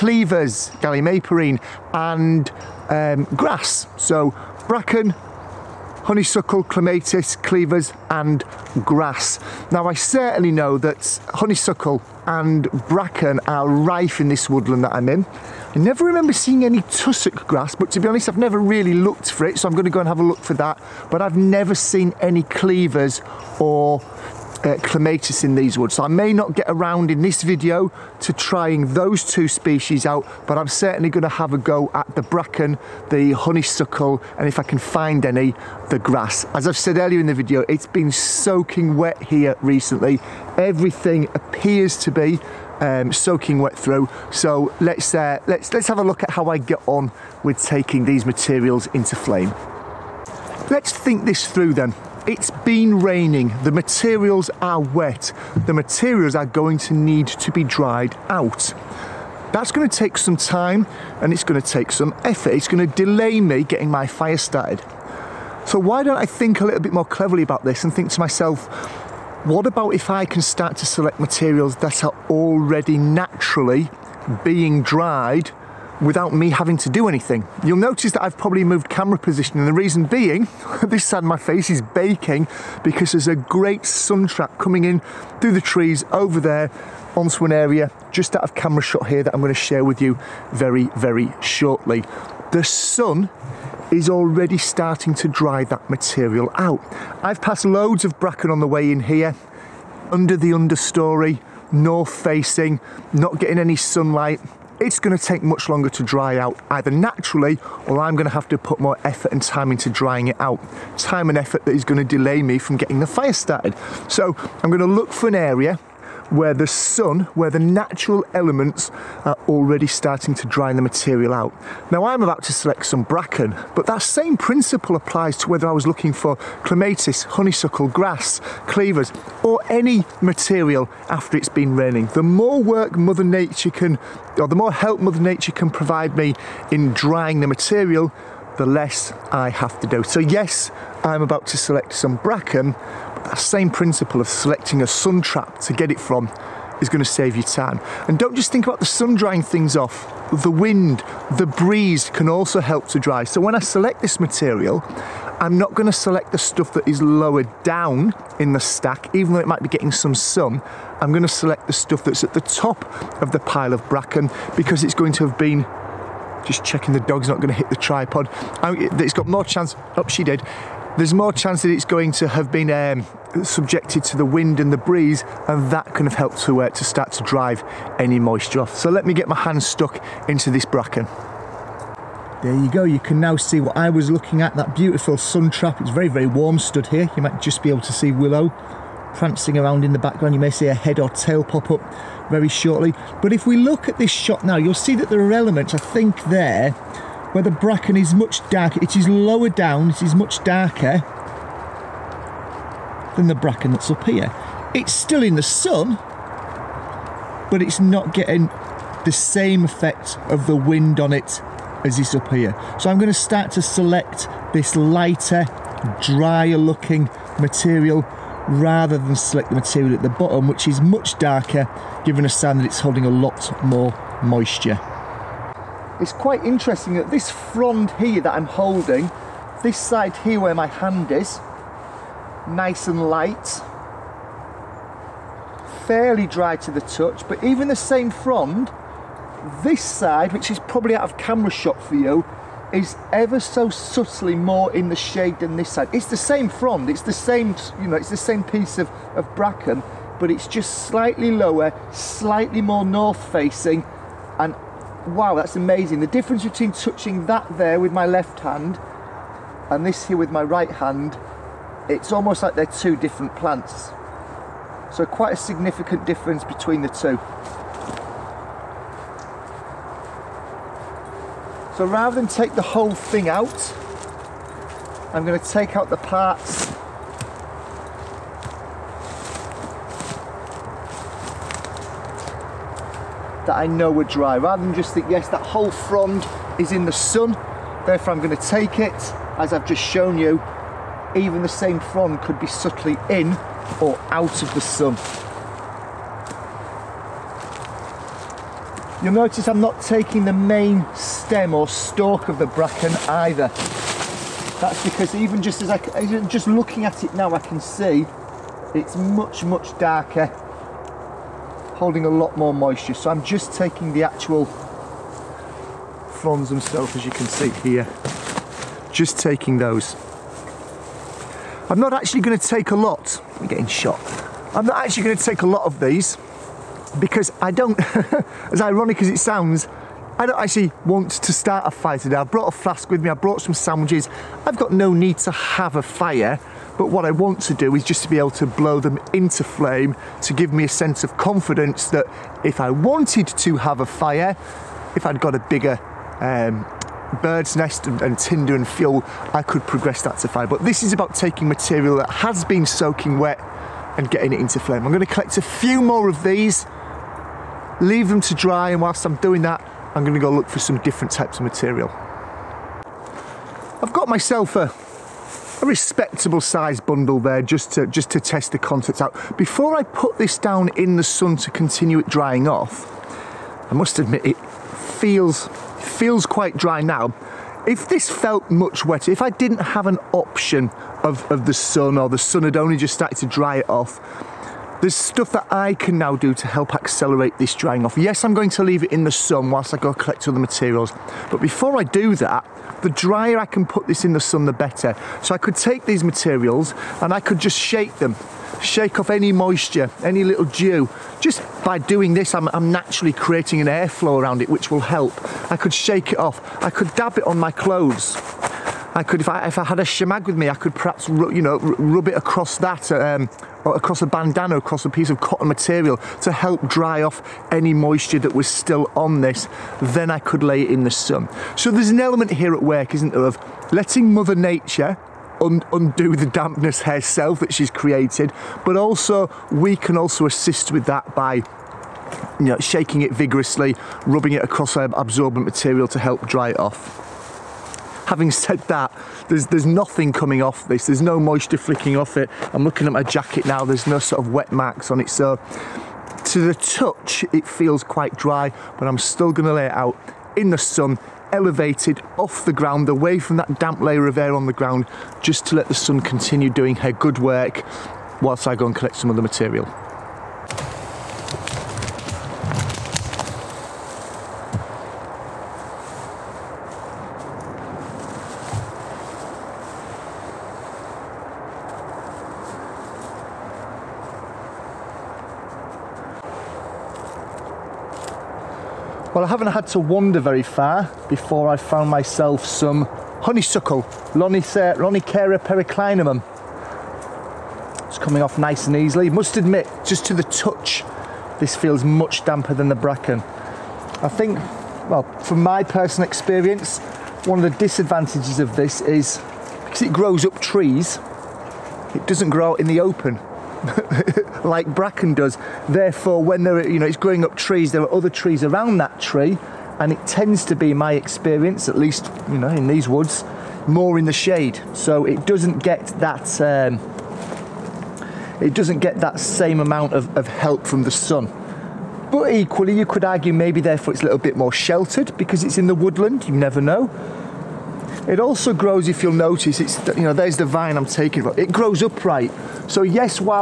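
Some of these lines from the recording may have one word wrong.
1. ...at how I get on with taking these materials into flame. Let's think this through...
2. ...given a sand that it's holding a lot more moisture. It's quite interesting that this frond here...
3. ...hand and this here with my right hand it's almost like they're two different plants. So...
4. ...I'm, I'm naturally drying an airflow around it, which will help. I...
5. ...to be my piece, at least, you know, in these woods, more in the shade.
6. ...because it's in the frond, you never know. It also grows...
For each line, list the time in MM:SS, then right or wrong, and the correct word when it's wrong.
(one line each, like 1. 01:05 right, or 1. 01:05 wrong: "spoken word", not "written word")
1. 00:46 right
2. 03:42 right
3. 04:18 right
4. 06:42 wrong: "creating", not "drying"
5. 08:30 wrong: "experience", not "piece"
6. 08:45 wrong: "woodland", not "frond".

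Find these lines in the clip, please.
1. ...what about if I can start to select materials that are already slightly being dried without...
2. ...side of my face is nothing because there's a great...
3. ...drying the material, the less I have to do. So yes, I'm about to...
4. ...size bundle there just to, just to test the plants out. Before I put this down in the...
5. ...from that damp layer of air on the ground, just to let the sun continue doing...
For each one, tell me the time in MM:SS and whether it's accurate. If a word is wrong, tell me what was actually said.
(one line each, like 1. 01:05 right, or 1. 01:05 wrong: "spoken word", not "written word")
1. 01:09 wrong: "naturally", not "slightly"
2. 01:21 wrong: "baking", not "nothing"
3. 02:16 right
4. 06:06 wrong: "contents", not "plants"
5. 07:33 right.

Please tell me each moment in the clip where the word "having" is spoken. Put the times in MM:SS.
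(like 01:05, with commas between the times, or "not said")
01:16, 07:18.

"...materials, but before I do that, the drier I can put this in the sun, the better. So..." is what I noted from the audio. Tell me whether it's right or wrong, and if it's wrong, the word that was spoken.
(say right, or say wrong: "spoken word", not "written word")
right.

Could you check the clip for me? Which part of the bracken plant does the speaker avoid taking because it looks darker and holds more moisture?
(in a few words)
main stem.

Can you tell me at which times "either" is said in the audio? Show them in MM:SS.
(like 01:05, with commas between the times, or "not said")
01:46, 05:03.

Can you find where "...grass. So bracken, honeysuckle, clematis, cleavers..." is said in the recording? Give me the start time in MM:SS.
00:03.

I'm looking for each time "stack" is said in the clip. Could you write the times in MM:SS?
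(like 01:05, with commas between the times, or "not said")
02:38.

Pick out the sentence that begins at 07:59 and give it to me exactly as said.
I haven't had to wander very far before I found myself some honeysuckle, Lonicera periclymenum.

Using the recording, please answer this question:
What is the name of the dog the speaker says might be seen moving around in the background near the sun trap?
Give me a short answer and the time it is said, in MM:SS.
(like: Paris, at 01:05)
Willow, at 03:08.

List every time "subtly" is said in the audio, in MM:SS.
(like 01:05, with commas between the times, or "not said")
04:03, 04:52.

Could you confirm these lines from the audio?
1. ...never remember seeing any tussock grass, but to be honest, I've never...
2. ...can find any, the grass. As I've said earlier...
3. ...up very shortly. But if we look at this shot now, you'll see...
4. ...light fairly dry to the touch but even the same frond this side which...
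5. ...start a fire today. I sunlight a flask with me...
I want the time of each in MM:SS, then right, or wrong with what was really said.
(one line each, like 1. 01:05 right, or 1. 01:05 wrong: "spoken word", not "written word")
1. 00:15 right
2. 00:34 right
3. 03:11 right
4. 03:53 right
5. 05:31 wrong: "brought", not "sunlight".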